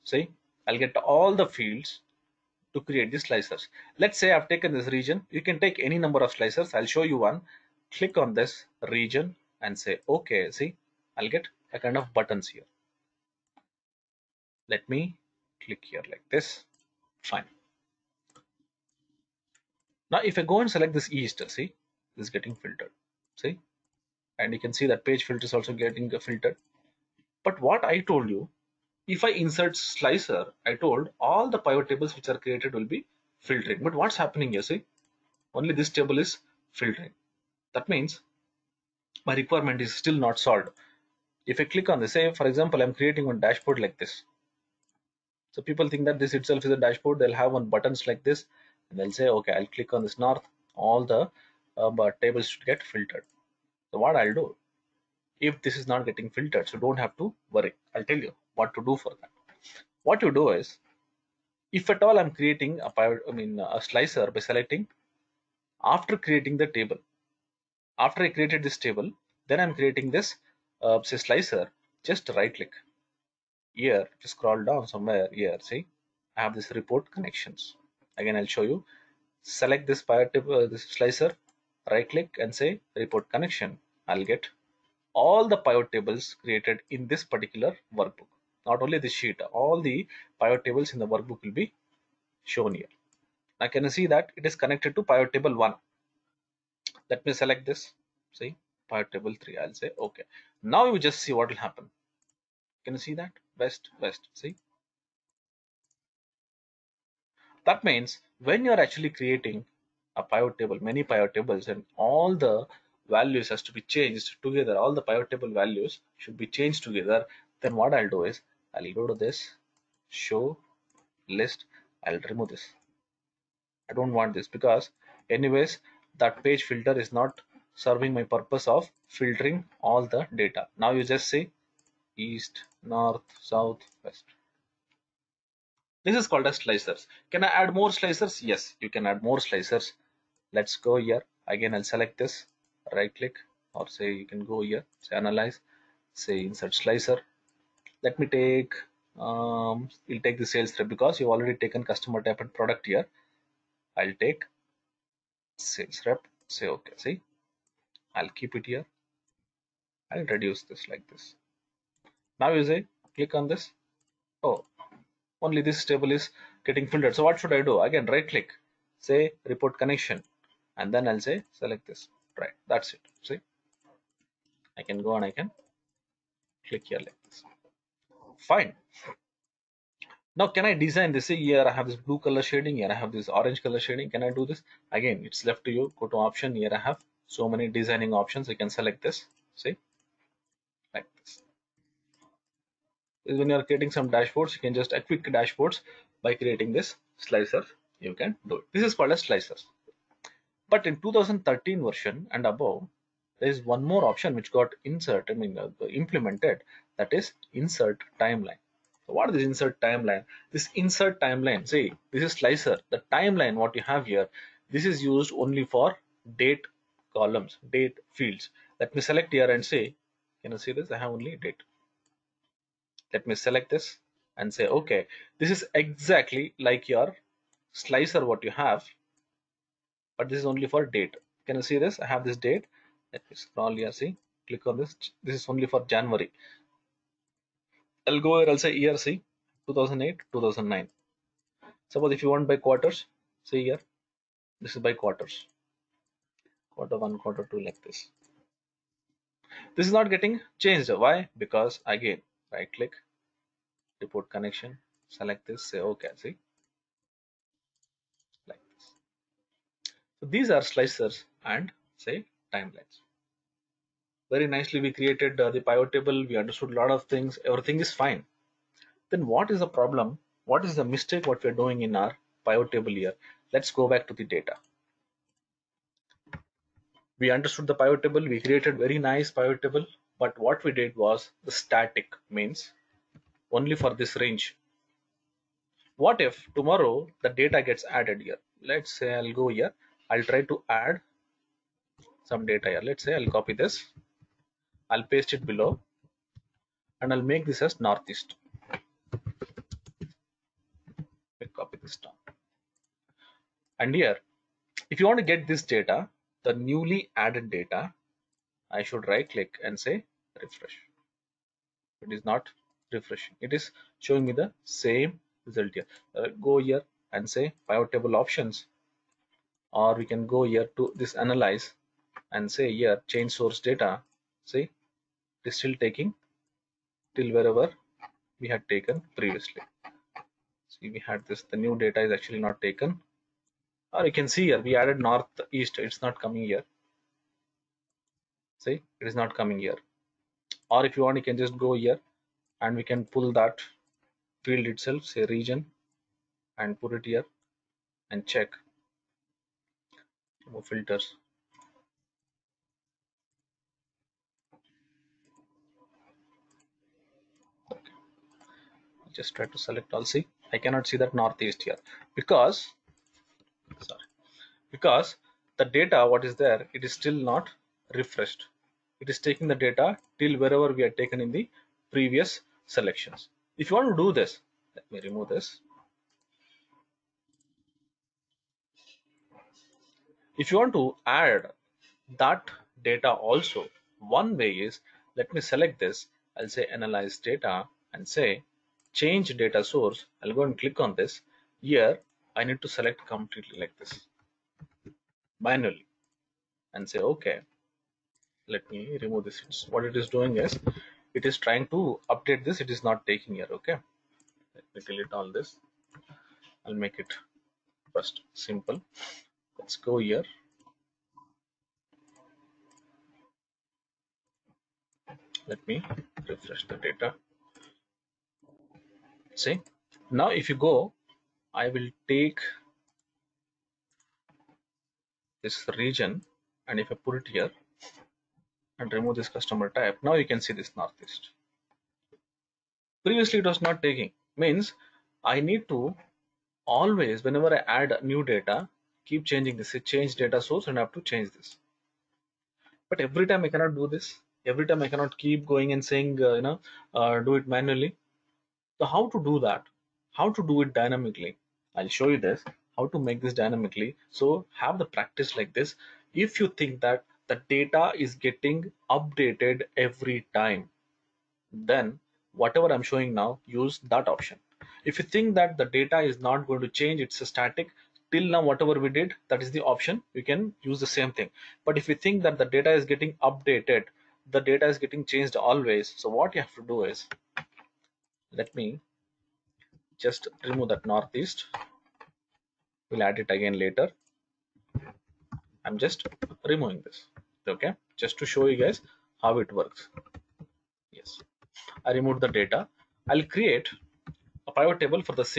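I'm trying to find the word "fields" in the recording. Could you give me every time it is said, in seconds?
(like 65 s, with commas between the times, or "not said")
1 s, 218 s, 344 s.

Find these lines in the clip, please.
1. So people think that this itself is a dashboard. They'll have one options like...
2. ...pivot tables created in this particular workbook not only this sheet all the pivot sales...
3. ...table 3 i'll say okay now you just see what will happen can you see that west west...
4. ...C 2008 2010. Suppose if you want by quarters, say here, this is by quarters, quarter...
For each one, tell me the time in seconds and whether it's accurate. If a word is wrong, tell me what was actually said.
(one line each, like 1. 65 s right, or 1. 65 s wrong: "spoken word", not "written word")
1. 45 s wrong: "buttons", not "options"
2. 85 s wrong: "tables", not "sales"
3. 99 s right
4. 238 s wrong: "2009", not "2010".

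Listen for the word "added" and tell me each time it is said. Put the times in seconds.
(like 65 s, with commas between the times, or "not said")
287 s, 307 s, 334 s.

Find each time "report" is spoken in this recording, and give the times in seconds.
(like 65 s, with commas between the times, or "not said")
76 s, 82 s, 169 s, 254 s.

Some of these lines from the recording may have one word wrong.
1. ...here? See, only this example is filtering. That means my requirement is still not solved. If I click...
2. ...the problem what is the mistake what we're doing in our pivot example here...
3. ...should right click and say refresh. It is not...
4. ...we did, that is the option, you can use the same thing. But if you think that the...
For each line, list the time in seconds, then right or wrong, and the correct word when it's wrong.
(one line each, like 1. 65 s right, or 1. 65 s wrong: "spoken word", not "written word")
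1. 34 s wrong: "table", not "example"
2. 269 s wrong: "table", not "example"
3. 308 s right
4. 468 s right.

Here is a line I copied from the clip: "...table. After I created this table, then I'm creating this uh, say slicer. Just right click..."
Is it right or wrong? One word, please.
right.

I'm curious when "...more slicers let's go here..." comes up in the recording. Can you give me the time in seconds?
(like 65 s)
139 s.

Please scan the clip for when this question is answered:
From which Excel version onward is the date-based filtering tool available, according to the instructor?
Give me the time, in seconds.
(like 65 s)
200 s.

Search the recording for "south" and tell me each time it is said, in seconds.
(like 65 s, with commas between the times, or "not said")
133 s.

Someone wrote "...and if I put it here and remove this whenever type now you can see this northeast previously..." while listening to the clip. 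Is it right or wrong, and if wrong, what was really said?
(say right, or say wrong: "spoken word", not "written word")
wrong: "customer", not "whenever".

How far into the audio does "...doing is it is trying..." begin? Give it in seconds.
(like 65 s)
400 s.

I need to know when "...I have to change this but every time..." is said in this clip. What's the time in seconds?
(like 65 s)
440 s.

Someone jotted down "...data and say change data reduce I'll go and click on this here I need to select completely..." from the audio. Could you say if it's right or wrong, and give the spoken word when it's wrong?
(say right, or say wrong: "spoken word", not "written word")
wrong: "source", not "reduce".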